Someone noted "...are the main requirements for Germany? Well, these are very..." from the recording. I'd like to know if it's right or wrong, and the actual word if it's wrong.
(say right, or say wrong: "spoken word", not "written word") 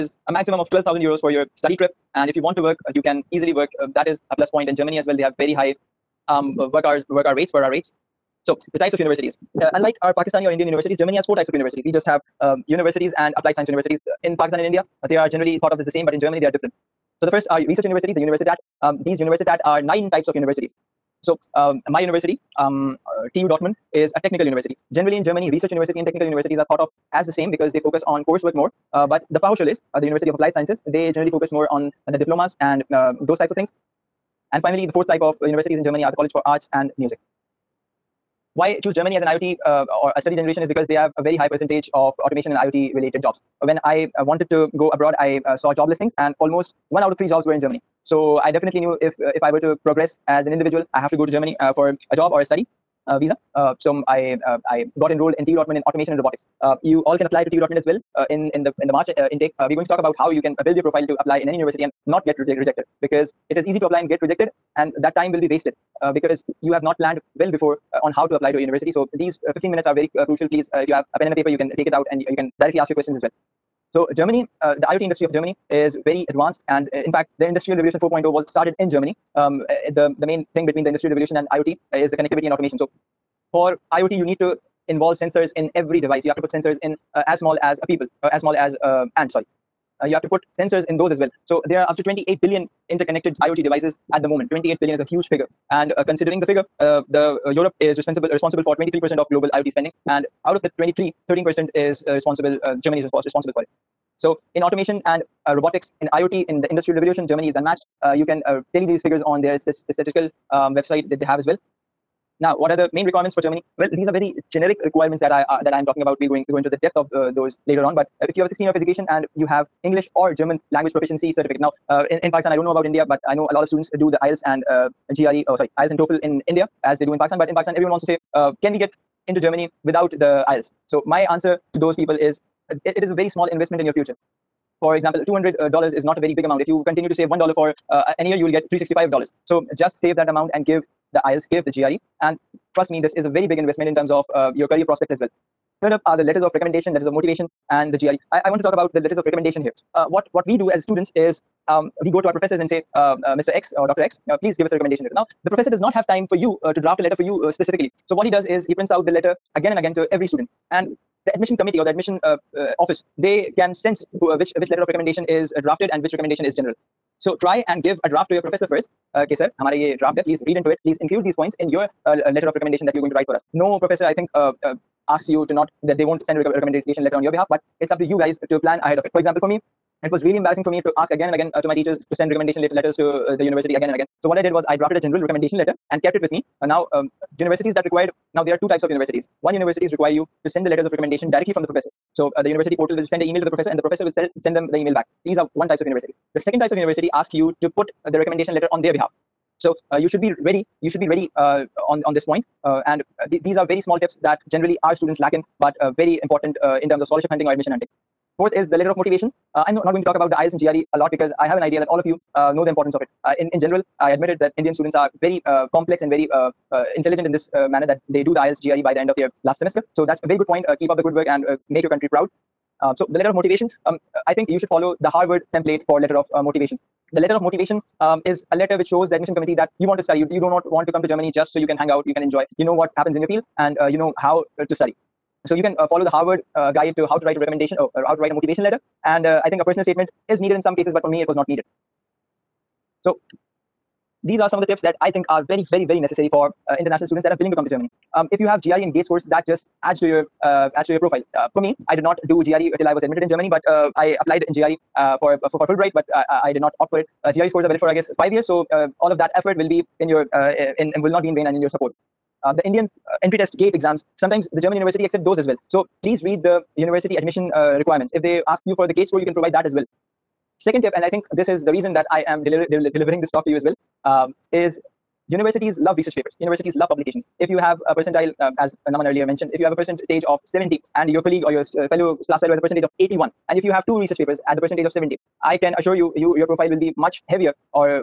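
right.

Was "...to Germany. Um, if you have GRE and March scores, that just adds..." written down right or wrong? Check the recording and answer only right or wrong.
wrong.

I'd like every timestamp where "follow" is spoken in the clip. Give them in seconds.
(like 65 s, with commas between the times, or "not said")
224 s, 235 s.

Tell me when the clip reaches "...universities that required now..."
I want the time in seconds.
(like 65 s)
187 s.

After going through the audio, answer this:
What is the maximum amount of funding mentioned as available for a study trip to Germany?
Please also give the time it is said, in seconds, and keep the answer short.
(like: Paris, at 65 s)
12,000 euros, at 0 s.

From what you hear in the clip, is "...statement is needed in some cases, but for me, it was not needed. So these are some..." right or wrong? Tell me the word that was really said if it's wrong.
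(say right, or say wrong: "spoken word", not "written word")
right.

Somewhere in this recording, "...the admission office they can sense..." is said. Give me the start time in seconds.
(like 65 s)
161 s.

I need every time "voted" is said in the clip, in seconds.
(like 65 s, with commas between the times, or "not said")
not said.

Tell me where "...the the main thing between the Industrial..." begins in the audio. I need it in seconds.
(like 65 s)
79 s.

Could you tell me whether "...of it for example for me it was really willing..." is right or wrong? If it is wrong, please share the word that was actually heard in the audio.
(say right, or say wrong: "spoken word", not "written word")
wrong: "embarrassing", not "willing".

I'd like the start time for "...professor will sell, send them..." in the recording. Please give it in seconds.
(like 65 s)
193 s.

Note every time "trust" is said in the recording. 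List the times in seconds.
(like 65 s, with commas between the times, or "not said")
142 s.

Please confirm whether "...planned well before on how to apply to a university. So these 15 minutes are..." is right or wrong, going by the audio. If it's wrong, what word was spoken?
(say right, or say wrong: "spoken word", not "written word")
right.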